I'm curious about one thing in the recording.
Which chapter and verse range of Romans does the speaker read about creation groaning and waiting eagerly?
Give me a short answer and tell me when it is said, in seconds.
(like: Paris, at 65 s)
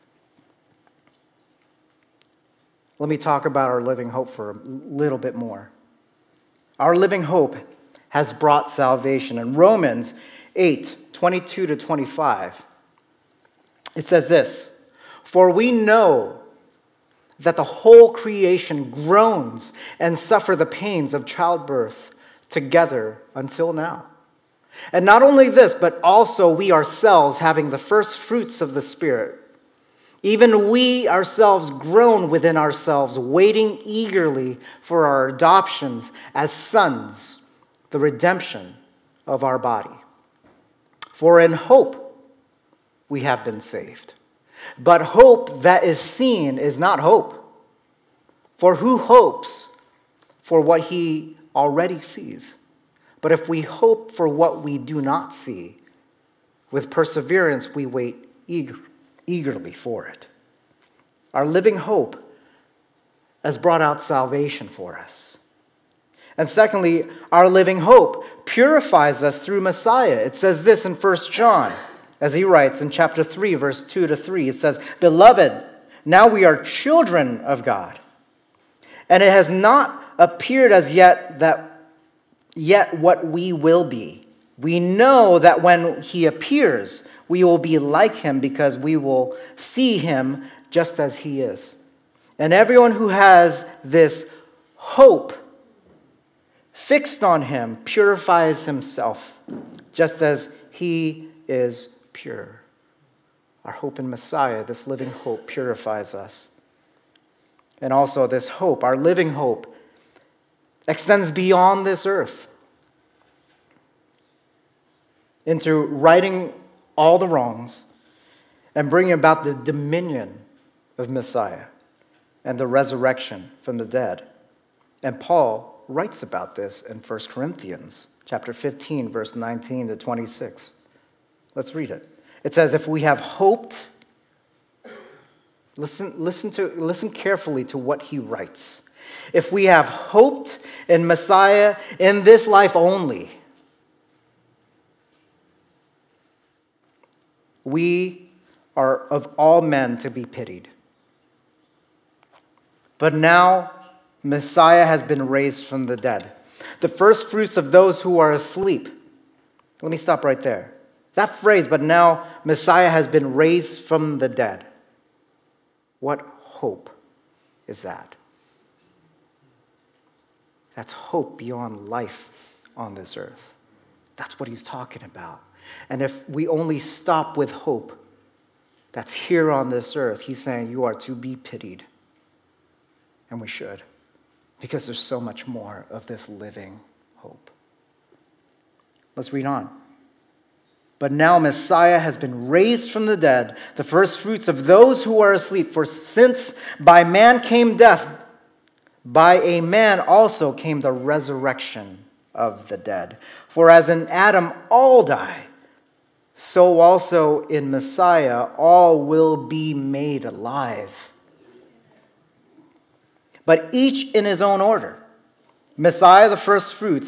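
Romans 8:22-25, at 9 s.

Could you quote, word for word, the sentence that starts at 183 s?
And we should because there's so much more of this living hope.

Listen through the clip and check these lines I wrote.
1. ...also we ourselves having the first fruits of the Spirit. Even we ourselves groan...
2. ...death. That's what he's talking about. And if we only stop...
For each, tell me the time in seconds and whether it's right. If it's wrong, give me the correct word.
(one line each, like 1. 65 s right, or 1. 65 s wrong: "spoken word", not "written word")
1. 26 s right
2. 173 s wrong: "earth", not "death".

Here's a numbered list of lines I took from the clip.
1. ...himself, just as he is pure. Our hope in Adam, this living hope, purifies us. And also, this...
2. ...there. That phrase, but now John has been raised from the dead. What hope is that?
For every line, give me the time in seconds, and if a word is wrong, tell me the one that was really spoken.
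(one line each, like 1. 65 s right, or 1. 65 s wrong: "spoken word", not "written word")
1. 98 s wrong: "Messiah", not "Adam"
2. 160 s wrong: "Messiah", not "John".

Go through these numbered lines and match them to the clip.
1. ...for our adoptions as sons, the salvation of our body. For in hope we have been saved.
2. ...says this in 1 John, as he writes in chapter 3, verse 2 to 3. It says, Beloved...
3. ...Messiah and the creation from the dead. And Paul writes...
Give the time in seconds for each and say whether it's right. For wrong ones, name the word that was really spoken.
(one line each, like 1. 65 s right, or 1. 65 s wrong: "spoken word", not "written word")
1. 34 s wrong: "redemption", not "salvation"
2. 70 s right
3. 121 s wrong: "resurrection", not "creation".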